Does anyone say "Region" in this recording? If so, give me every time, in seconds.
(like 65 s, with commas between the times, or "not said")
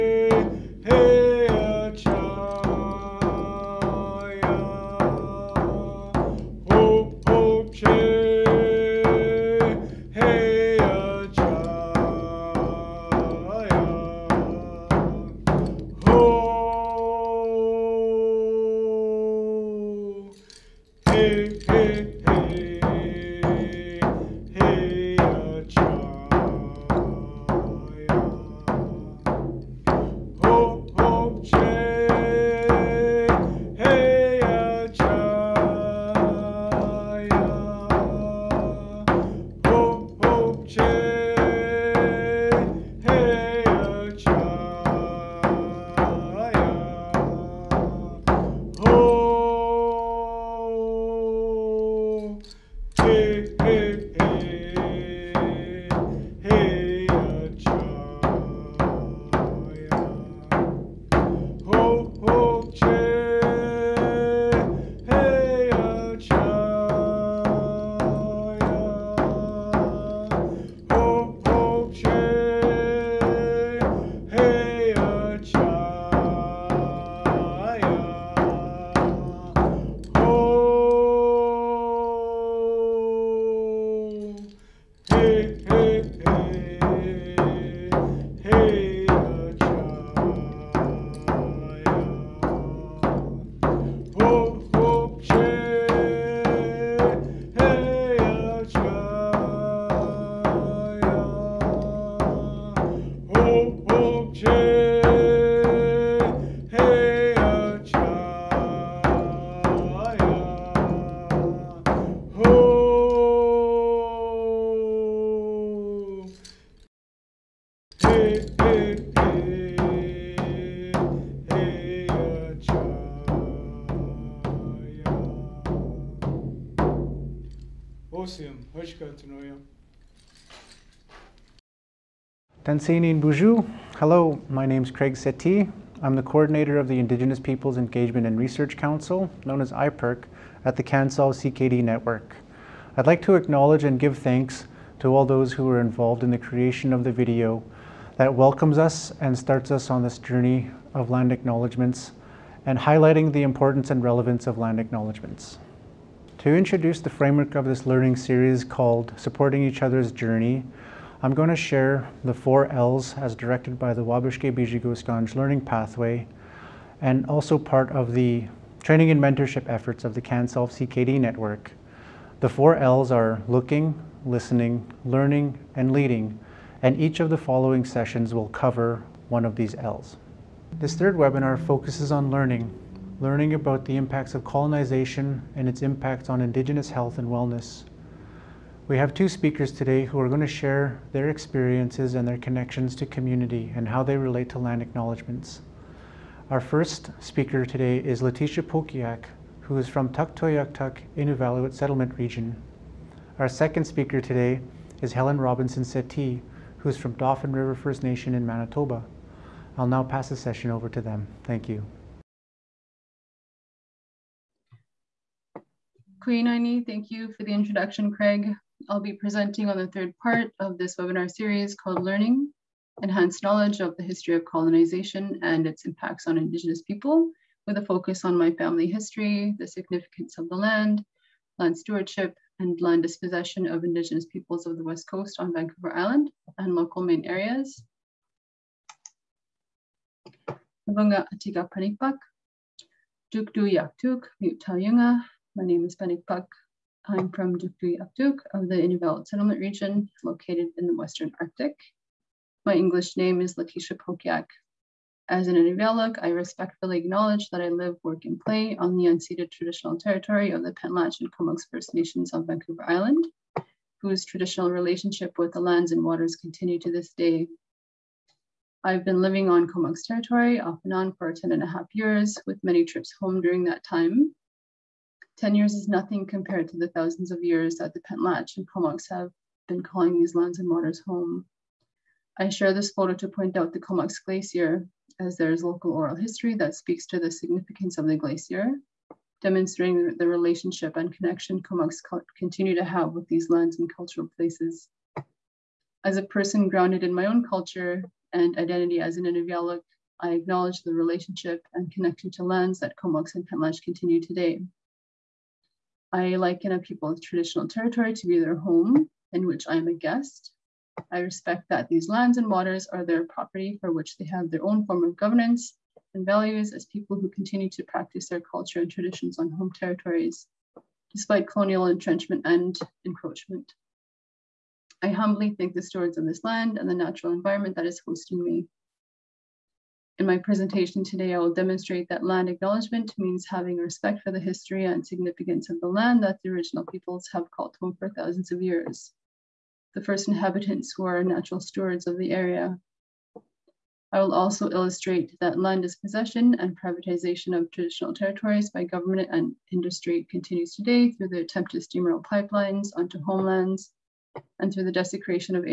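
202 s, 249 s.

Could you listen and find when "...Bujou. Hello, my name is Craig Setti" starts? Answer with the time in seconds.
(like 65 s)
133 s.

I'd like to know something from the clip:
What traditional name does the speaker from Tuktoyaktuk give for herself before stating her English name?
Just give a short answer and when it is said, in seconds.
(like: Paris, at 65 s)
Panikpak, at 245 s.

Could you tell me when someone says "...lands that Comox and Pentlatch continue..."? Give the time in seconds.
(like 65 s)
302 s.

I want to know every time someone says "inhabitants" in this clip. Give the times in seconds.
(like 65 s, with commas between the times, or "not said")
340 s.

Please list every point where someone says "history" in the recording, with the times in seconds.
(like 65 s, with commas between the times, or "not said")
224 s, 228 s, 286 s, 334 s.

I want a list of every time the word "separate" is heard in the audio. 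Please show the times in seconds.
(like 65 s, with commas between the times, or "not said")
not said.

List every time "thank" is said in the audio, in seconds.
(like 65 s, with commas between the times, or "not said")
144 s, 211 s, 216 s, 325 s.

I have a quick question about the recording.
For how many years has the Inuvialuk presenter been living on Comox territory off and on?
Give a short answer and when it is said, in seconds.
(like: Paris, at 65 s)
10 and a half years, at 271 s.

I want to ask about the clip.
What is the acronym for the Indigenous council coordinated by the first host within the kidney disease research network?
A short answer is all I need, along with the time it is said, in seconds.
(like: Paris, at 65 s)
IPERC, at 139 s.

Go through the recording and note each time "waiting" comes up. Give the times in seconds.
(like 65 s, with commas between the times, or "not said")
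not said.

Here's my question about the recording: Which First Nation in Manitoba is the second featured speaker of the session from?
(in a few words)
Dauphin River First Nation.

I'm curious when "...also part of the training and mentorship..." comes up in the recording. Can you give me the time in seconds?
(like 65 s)
167 s.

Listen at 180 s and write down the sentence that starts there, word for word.
This third webinar focuses on learning, learning about the impacts of colonization and its impacts on Indigenous health and wellness.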